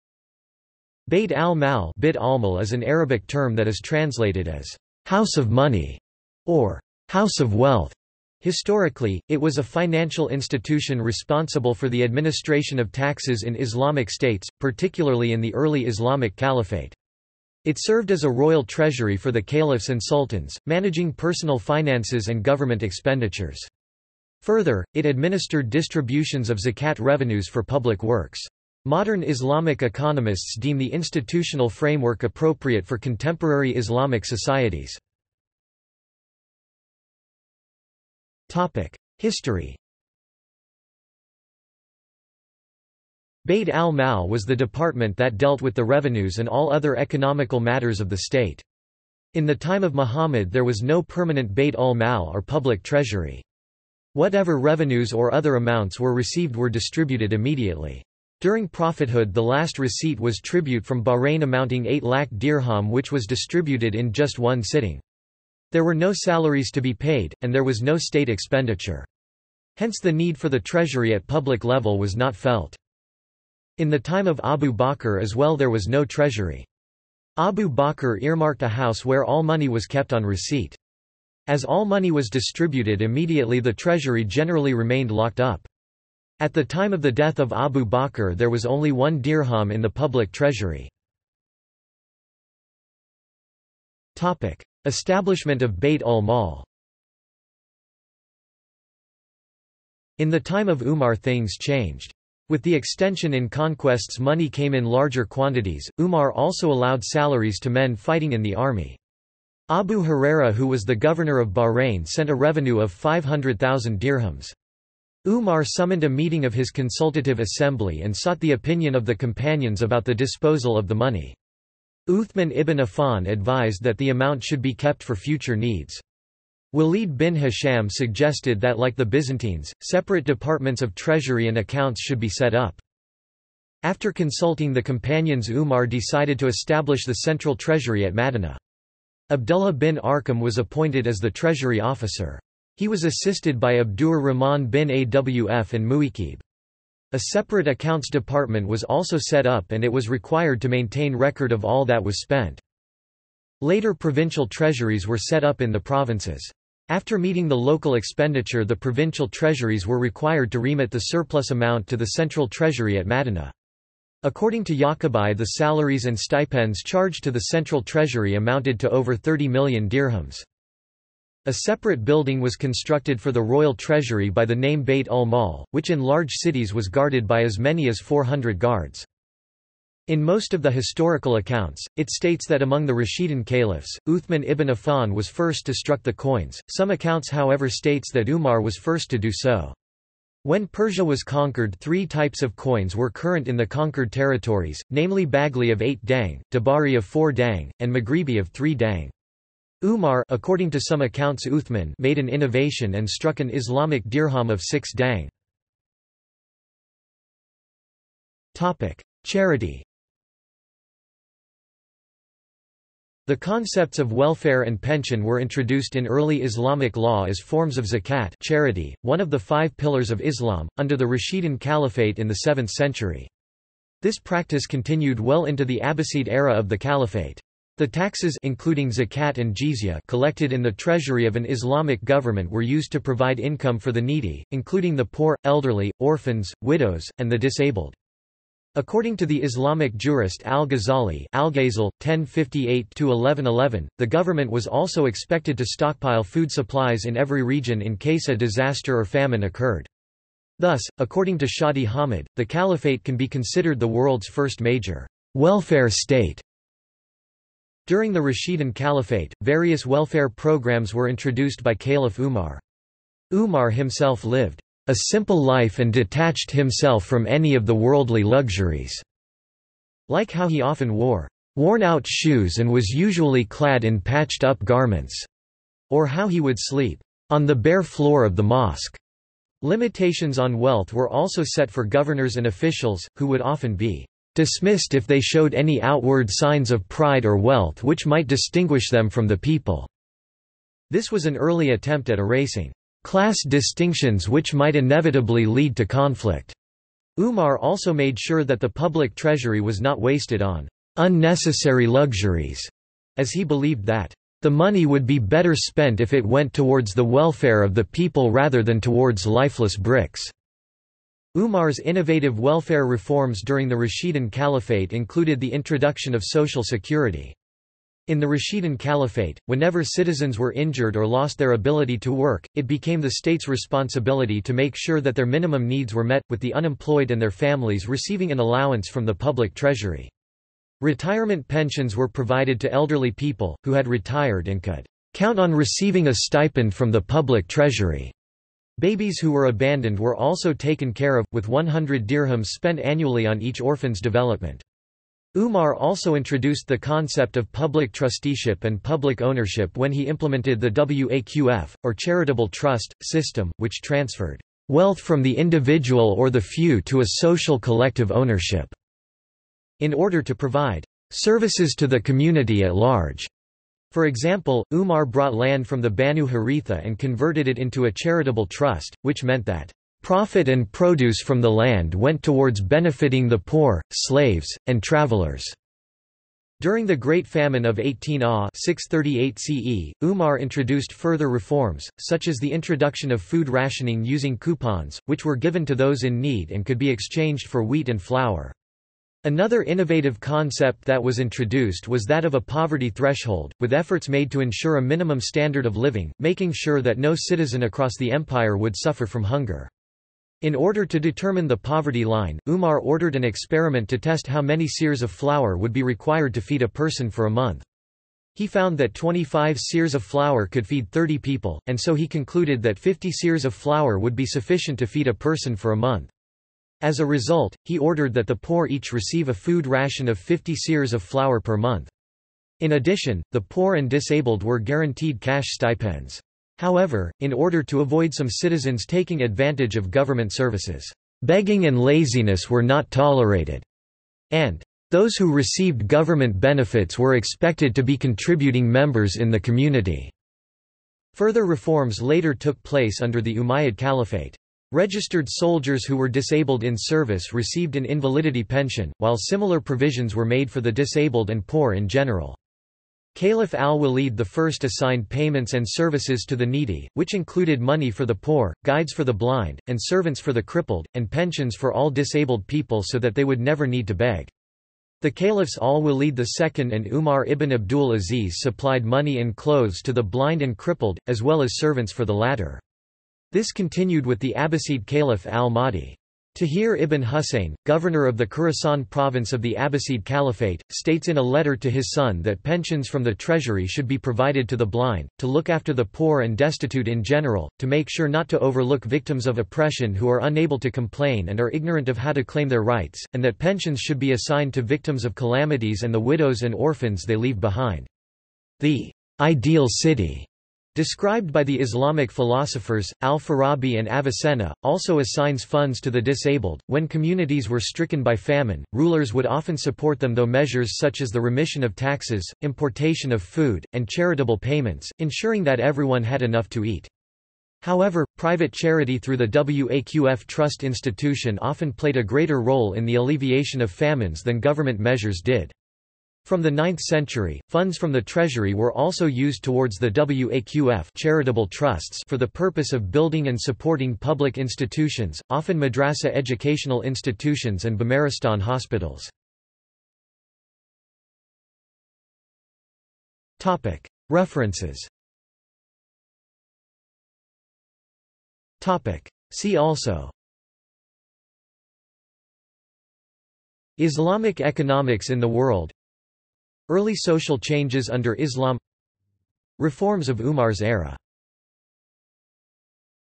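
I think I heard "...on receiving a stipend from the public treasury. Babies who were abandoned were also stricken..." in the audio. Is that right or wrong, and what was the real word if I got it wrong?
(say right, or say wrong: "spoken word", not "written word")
wrong: "taken", not "stricken".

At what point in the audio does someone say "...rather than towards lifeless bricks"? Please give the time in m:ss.
5:08.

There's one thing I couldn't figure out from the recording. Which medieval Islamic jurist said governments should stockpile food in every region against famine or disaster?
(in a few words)
Al-Ghazali.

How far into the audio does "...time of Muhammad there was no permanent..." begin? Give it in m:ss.
0:49.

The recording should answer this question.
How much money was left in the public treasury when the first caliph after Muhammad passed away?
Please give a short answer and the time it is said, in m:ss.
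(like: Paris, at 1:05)
1 dirham, at 1:28.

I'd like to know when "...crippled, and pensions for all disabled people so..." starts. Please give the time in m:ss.
7:40.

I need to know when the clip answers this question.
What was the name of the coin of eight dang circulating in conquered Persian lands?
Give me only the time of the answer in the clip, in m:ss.
3:15.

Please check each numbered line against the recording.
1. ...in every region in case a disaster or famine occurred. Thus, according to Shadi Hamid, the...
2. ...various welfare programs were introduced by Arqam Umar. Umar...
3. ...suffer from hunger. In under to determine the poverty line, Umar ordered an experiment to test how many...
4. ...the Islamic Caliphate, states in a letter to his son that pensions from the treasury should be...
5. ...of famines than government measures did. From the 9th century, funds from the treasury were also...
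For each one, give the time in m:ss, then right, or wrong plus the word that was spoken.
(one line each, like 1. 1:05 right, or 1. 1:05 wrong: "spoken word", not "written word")
1. 4:07 right
2. 4:19 wrong: "Caliph", not "Arqam"
3. 6:38 wrong: "order", not "under"
4. 7:59 wrong: "Abbasid", not "Islamic"
5. 8:43 right.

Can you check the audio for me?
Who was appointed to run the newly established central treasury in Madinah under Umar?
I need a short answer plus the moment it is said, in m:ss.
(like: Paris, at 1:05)
Abdullah bin Arqam, at 2:19.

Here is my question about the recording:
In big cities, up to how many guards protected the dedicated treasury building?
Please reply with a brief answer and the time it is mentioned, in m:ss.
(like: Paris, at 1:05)
400, at 2:57.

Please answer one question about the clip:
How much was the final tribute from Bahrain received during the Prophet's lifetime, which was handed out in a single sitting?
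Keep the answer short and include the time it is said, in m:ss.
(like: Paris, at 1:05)
8 lakh dirham, at 1:01.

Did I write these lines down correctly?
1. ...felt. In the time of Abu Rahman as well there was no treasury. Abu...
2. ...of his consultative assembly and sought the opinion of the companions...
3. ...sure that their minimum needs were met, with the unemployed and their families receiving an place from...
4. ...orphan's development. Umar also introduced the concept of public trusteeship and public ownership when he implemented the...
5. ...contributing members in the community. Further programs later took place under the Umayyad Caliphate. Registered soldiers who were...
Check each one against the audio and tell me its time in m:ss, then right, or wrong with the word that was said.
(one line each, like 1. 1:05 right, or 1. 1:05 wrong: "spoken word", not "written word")
1. 1:12 wrong: "Bakr", not "Rahman"
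2. 1:56 right
3. 5:24 wrong: "allowance", not "place"
4. 5:43 right
5. 7:17 wrong: "reforms", not "programs".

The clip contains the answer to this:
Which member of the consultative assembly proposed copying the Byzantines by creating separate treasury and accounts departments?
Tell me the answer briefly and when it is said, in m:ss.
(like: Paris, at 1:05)
Walid bin Hisham, at 2:06.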